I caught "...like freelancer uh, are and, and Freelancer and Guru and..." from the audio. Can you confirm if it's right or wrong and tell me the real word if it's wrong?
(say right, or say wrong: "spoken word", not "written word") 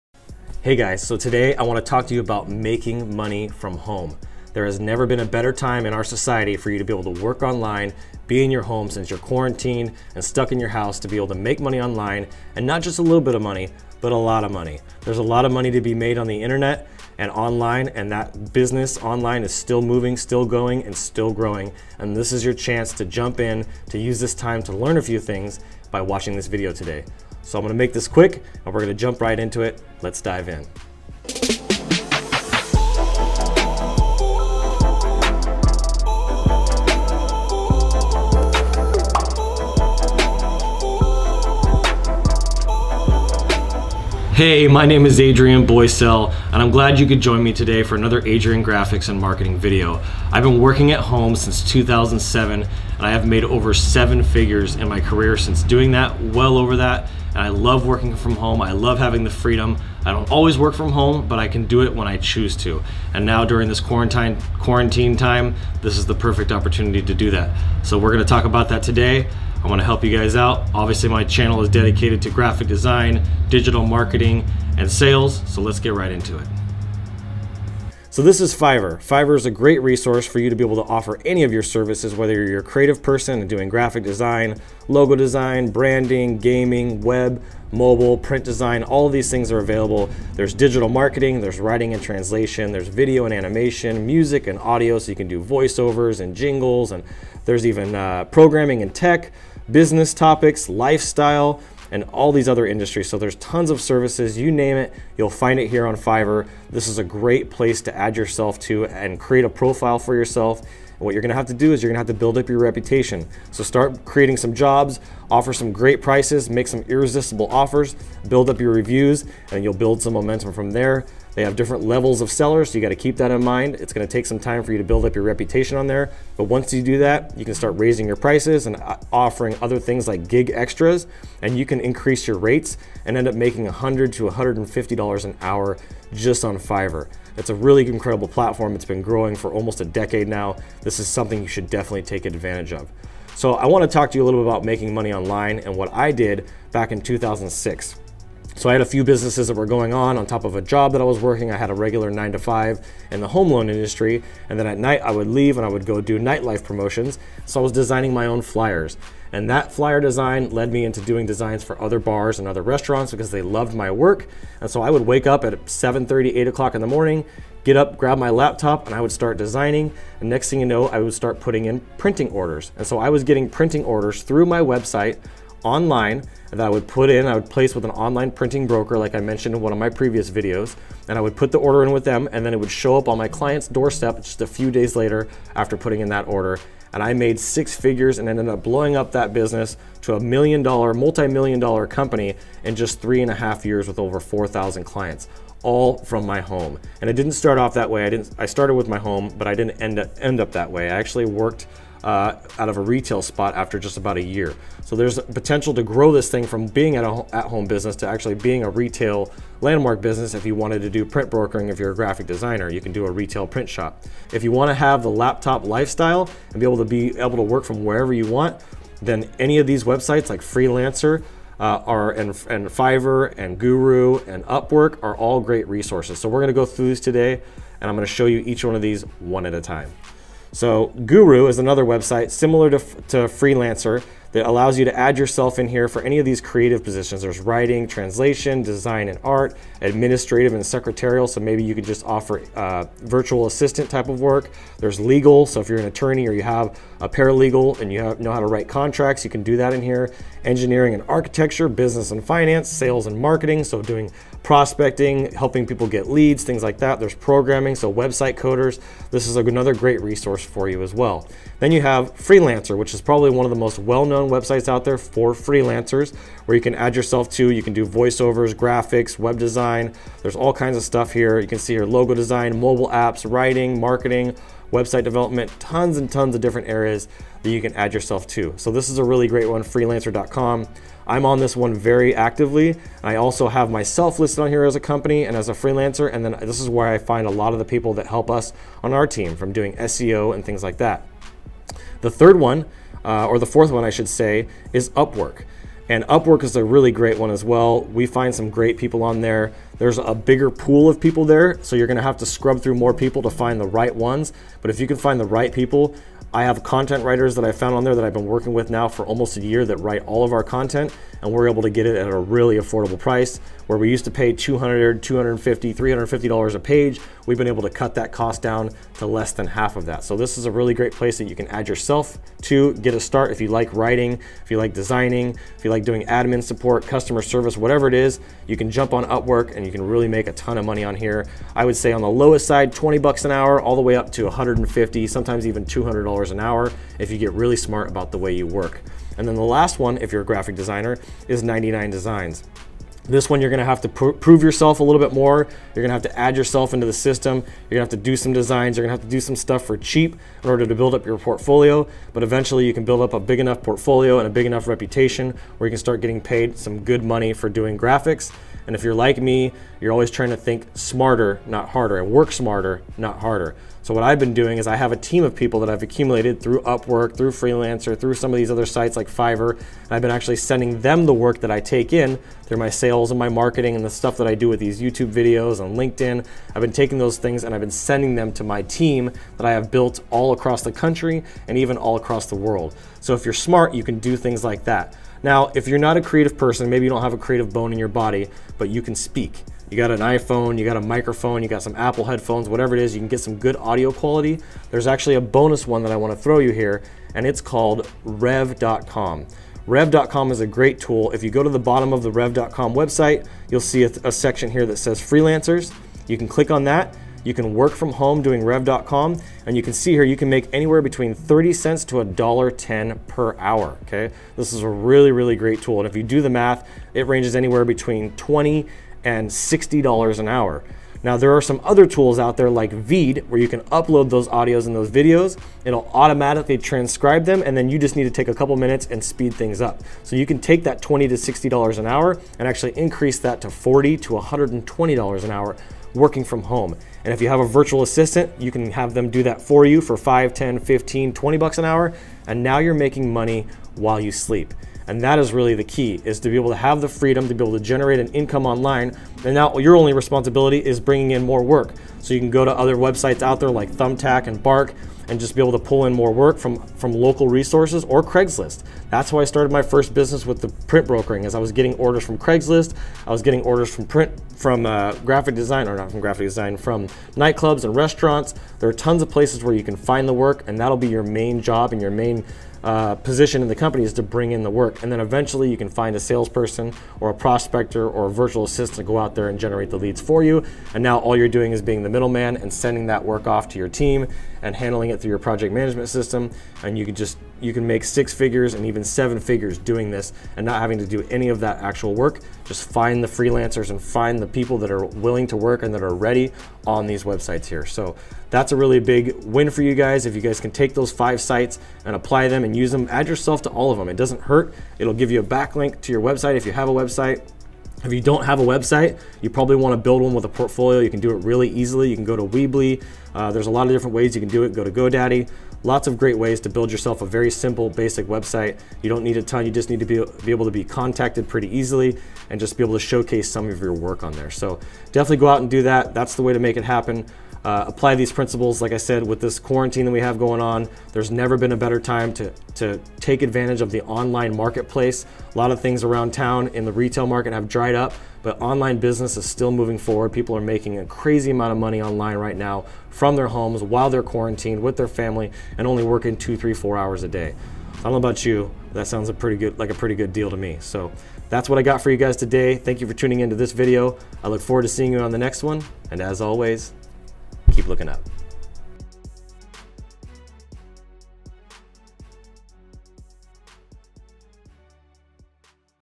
wrong: "Fiverr", not "Freelancer".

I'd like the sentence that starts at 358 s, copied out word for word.
And if you're like me, you're always trying to think smarter, not harder, and work smarter, not harder.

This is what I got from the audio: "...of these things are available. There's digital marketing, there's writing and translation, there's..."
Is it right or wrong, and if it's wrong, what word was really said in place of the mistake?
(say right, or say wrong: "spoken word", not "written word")
right.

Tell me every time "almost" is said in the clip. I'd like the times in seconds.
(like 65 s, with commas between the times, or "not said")
139 s, 309 s.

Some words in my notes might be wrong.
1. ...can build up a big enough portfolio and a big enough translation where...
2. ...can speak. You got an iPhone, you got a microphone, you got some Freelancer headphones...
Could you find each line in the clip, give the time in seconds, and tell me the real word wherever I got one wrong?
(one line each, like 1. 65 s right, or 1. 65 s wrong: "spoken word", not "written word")
1. 352 s wrong: "reputation", not "translation"
2. 388 s wrong: "Apple", not "Freelancer".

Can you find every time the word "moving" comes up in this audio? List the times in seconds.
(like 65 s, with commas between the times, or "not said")
19 s, 539 s.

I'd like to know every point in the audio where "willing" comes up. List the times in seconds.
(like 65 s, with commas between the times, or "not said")
494 s.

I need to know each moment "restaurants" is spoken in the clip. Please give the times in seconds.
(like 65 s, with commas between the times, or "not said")
162 s, 467 s.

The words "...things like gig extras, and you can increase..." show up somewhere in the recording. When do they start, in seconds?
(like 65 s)
129 s.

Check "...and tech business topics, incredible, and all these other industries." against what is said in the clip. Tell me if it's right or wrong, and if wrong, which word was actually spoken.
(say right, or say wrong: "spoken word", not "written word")
wrong: "lifestyle", not "incredible".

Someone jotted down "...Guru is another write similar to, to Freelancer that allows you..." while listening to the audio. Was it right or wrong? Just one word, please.
wrong.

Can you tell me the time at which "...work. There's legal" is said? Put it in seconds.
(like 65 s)
244 s.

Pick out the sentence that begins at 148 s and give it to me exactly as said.
So I had a few businesses that were going on on top of a job that I was working.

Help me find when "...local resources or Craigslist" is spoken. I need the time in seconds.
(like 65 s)
456 s.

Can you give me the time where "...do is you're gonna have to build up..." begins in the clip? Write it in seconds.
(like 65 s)
111 s.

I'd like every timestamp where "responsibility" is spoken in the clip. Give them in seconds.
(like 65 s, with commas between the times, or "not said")
449 s.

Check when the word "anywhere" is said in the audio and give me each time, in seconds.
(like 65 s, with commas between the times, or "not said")
410 s, 417 s.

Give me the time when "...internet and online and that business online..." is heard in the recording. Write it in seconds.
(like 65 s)
16 s.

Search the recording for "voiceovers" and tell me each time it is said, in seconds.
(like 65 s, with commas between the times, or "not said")
95 s, 267 s.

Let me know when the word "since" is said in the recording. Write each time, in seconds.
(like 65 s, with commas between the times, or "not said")
8 s, 51 s, 55 s.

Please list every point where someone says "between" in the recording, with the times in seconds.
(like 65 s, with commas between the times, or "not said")
410 s, 417 s.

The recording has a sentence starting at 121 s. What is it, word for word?
They have different levels of sellers, so you got to keep that in mind.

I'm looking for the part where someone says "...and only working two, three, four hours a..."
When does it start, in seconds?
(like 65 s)
545 s.